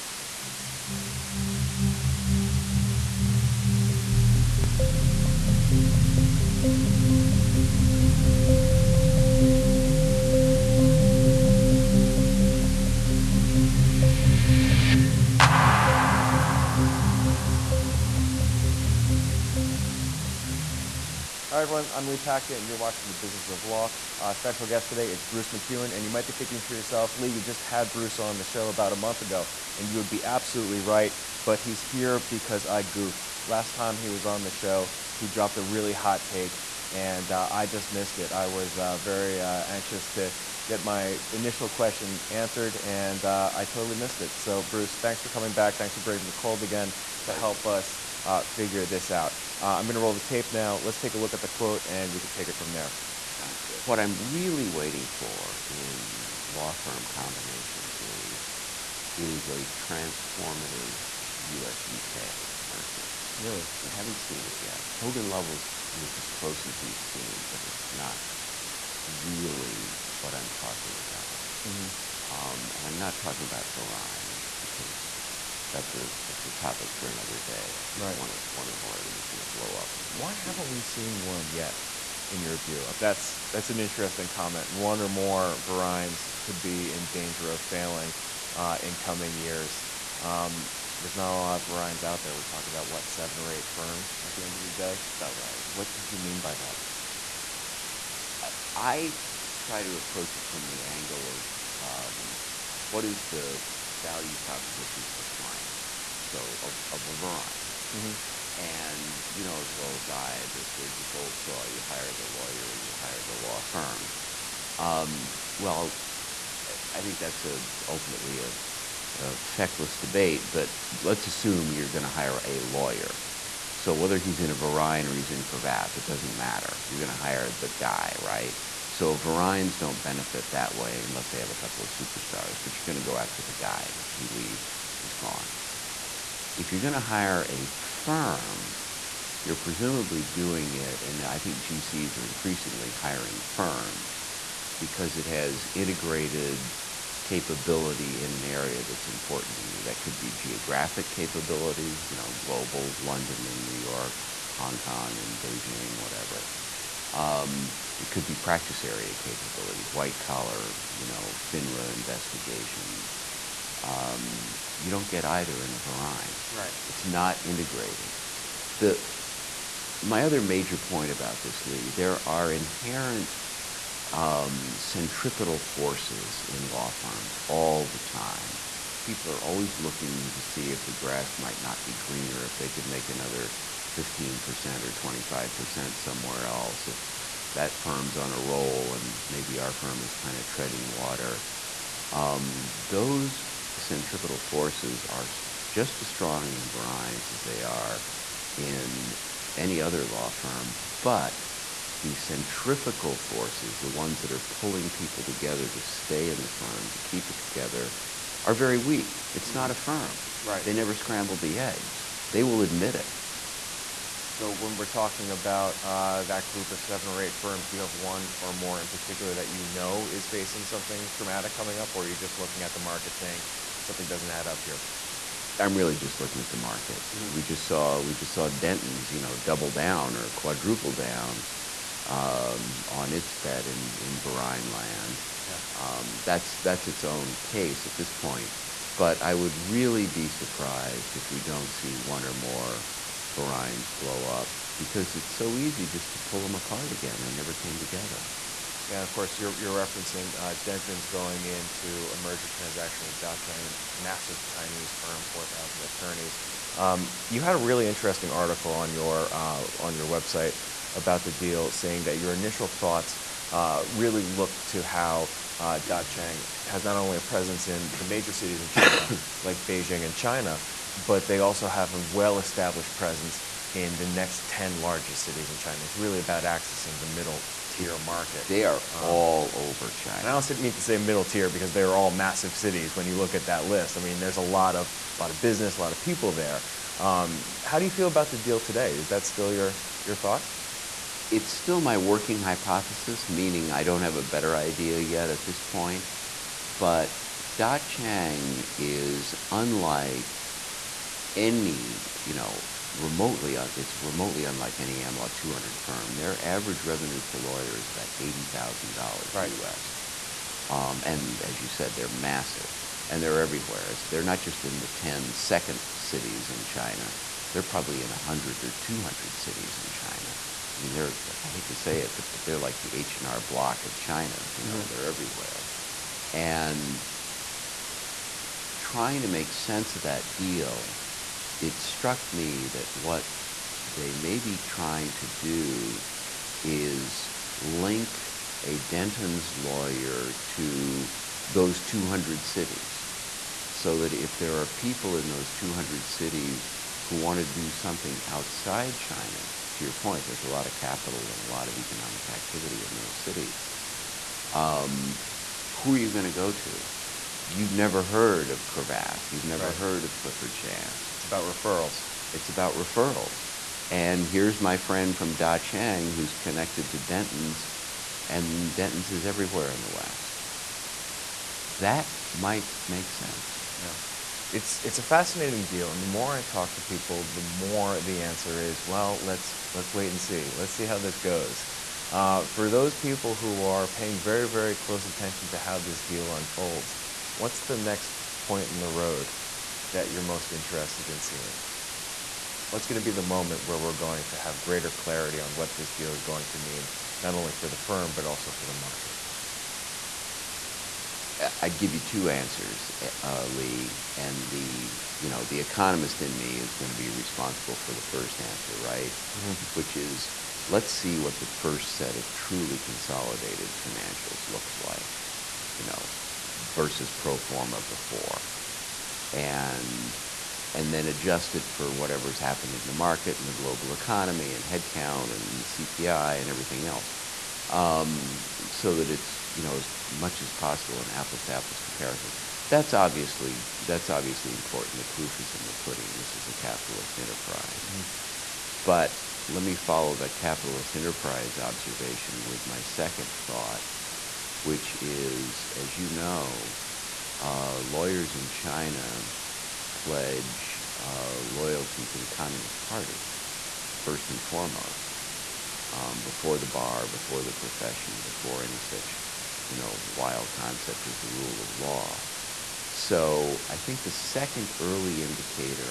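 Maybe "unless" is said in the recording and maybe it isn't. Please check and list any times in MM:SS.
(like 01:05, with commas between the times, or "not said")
02:11.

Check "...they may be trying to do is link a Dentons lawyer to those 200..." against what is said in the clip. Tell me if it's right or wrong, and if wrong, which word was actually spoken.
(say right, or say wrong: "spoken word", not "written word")
right.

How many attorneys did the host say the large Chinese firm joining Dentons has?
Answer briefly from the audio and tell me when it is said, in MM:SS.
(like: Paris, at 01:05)
4,000, at 04:15.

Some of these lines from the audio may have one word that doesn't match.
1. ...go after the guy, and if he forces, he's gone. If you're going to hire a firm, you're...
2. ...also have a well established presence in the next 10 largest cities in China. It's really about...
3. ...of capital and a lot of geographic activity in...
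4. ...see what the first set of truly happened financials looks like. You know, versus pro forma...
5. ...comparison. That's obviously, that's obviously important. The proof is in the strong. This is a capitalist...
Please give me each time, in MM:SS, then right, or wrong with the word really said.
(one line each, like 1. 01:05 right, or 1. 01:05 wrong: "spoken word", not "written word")
1. 02:13 wrong: "leaves", not "forces"
2. 04:31 right
3. 05:50 wrong: "economic", not "geographic"
4. 06:50 wrong: "consolidated", not "happened"
5. 07:11 wrong: "pudding", not "strong".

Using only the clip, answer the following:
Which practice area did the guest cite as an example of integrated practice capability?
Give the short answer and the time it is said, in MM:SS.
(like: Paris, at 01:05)
FINRA investigations, at 02:41.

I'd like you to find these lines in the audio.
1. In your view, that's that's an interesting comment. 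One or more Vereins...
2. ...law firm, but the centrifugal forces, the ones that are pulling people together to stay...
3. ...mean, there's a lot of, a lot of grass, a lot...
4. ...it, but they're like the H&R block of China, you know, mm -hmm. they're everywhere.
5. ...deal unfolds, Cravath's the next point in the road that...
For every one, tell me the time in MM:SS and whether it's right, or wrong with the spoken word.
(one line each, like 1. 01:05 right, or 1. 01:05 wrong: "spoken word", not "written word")
1. 01:22 right
2. 03:20 right
3. 04:44 wrong: "business", not "grass"
4. 05:21 right
5. 06:26 wrong: "What", not "Cravath".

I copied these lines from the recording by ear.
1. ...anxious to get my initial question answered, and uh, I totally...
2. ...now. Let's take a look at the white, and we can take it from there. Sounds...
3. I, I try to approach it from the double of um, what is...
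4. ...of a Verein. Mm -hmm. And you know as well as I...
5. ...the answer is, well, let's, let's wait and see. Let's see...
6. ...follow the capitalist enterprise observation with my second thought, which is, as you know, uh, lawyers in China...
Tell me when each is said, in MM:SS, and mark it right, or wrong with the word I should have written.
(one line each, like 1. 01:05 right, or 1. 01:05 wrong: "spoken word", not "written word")
1. 00:39 right
2. 00:50 wrong: "quote", not "white"
3. 01:38 wrong: "angle", not "double"
4. 01:46 right
5. 06:18 right
6. 07:19 right.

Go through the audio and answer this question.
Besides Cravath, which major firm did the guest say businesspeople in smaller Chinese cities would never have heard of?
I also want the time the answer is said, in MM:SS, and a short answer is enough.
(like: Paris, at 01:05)
Clifford Chance, at 06:00.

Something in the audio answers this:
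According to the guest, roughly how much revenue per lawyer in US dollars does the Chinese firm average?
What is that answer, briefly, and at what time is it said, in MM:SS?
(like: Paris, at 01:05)
$80,000, at 05:08.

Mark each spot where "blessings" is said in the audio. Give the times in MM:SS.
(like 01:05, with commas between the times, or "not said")
not said.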